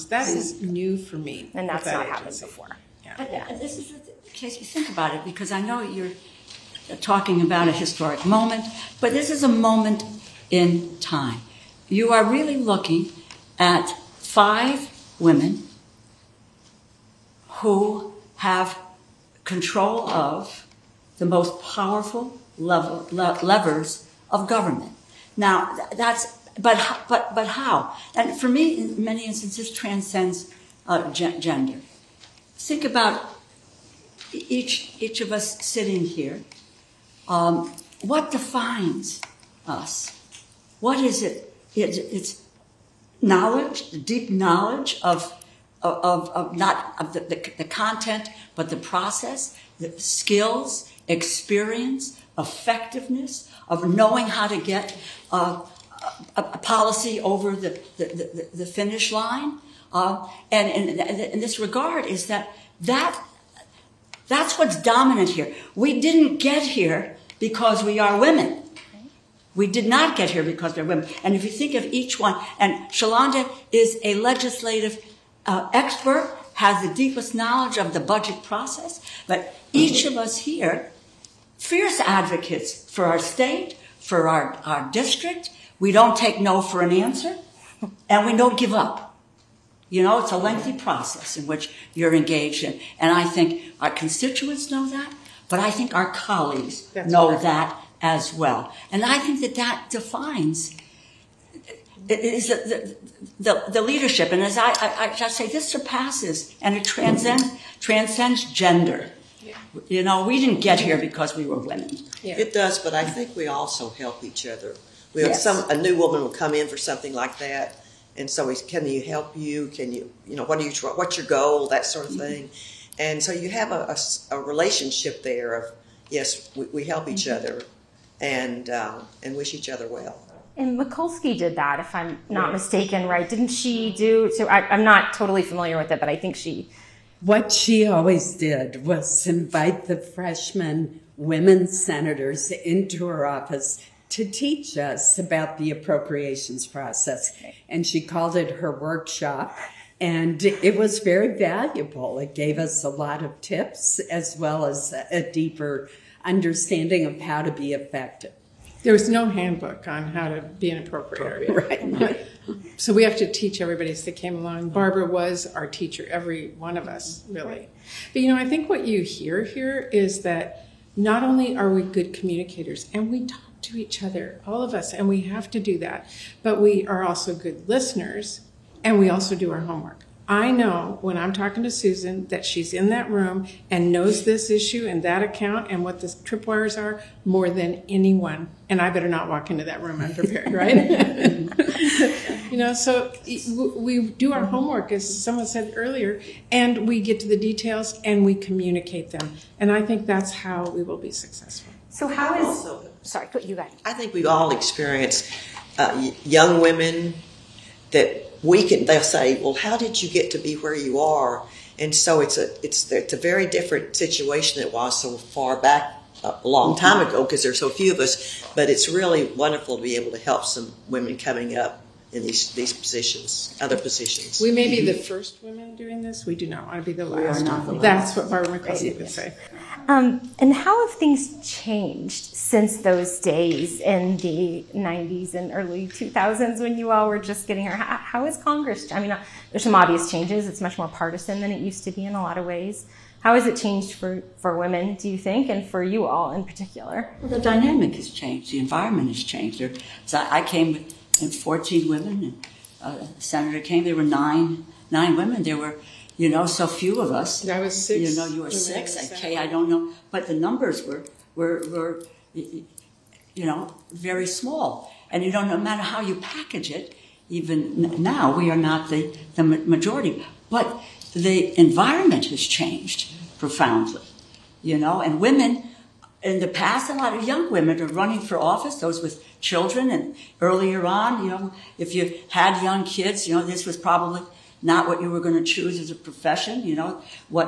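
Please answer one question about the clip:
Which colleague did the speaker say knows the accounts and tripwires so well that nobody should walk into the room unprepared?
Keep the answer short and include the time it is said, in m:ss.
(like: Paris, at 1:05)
Susan, at 3:01.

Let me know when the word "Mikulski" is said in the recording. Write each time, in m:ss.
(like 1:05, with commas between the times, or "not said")
2:10, 3:48.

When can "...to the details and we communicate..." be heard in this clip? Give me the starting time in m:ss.
3:17.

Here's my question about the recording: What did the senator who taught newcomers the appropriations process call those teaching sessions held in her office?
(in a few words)
Her workshop.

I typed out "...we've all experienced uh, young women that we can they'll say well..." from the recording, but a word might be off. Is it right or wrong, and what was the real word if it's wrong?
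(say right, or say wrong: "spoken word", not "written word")
right.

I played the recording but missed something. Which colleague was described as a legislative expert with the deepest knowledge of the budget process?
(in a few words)
Shalanda.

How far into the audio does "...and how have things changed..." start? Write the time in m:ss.
3:50.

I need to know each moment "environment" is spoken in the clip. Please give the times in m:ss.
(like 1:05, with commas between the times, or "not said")
4:08, 4:31.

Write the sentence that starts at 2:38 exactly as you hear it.
There was no handbook on how to be an appropriator, Right.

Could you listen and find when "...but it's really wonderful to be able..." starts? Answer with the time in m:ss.
3:38.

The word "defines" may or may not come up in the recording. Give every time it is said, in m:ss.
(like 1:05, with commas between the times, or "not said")
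0:38, 1:39.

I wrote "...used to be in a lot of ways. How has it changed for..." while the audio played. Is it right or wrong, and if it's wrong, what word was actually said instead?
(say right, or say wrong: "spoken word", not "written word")
right.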